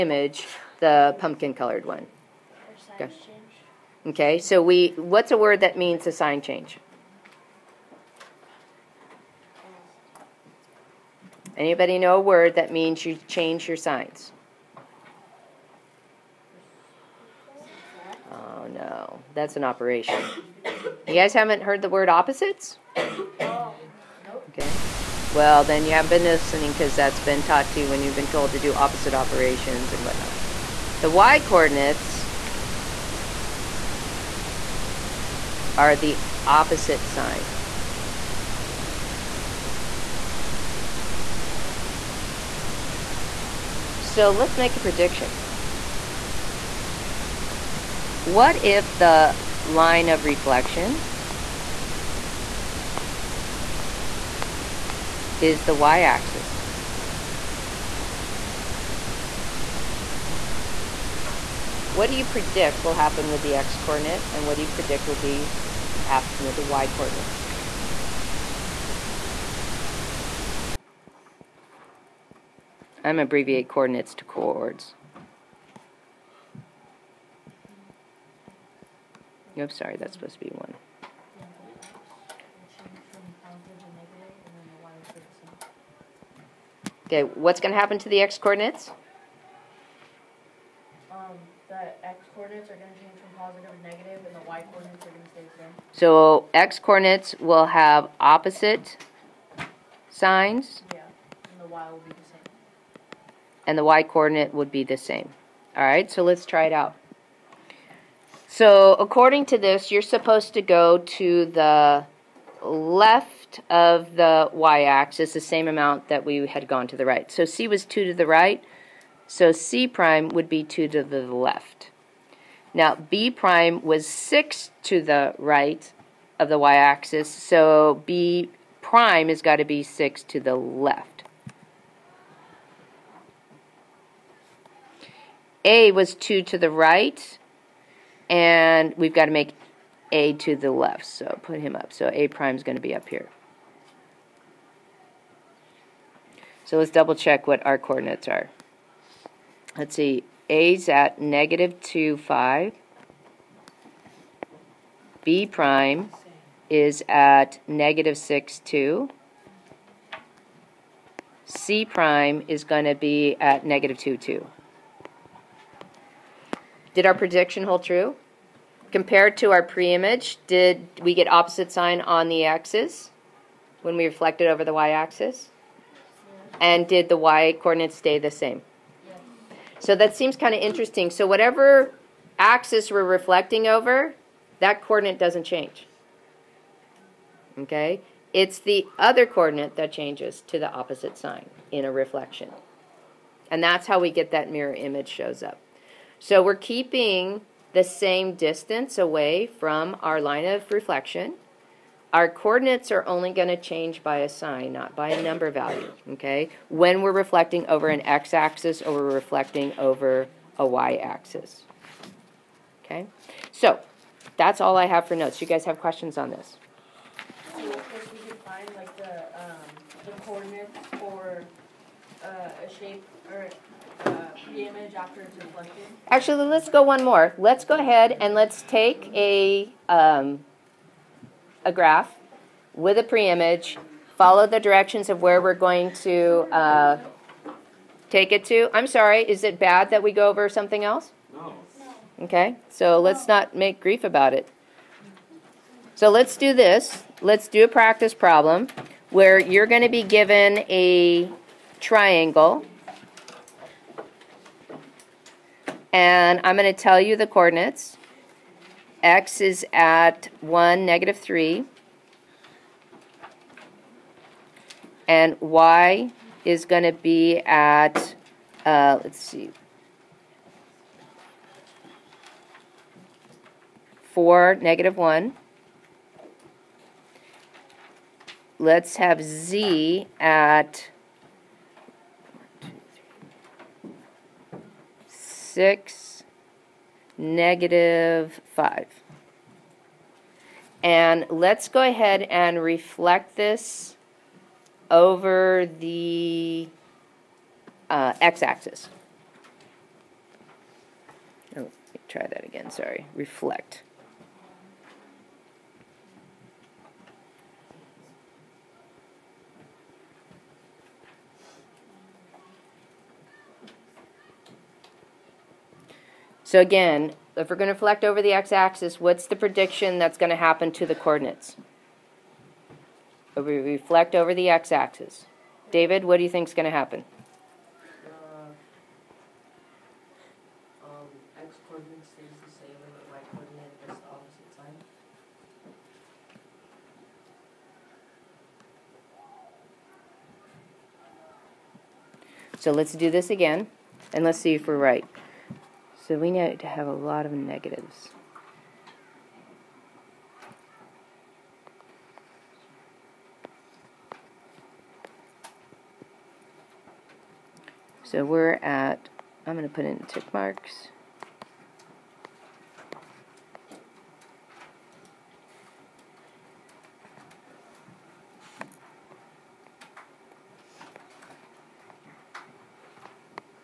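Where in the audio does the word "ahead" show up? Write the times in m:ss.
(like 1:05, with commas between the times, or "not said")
3:47, 4:51.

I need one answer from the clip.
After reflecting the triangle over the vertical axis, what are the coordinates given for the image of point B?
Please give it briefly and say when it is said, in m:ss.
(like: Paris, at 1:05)
-6, 2, at 2:37.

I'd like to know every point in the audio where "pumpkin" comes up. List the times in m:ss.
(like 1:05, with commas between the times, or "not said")
0:01.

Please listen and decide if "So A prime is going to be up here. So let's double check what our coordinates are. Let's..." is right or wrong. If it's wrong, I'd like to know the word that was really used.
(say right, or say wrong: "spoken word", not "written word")
right.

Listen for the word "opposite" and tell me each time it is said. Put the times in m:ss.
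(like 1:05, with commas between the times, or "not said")
0:22, 0:28, 0:36, 1:38, 2:51, 3:10.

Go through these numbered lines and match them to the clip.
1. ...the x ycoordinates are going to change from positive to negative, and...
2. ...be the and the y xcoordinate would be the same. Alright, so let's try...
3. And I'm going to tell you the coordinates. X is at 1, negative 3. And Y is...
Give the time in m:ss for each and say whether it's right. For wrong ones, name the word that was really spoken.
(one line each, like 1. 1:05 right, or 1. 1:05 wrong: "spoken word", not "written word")
1. 1:31 wrong: "coordinates", not "ycoordinates"
2. 1:42 wrong: "coordinate", not "xcoordinate"
3. 4:15 right.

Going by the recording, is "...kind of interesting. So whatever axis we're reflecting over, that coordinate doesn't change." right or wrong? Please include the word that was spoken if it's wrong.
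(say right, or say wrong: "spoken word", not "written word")
right.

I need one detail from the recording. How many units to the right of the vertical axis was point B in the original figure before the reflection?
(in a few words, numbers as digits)
6.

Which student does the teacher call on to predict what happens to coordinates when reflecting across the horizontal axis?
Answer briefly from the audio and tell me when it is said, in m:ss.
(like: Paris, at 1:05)
David, at 5:25.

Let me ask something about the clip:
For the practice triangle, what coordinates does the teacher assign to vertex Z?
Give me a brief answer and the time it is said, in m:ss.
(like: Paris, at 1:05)
6, -5, at 4:45.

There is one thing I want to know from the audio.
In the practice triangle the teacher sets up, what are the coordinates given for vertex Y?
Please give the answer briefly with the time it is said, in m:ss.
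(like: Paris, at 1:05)
4, -1, at 4:34.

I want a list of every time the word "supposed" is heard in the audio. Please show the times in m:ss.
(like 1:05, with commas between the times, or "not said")
1:20, 1:50.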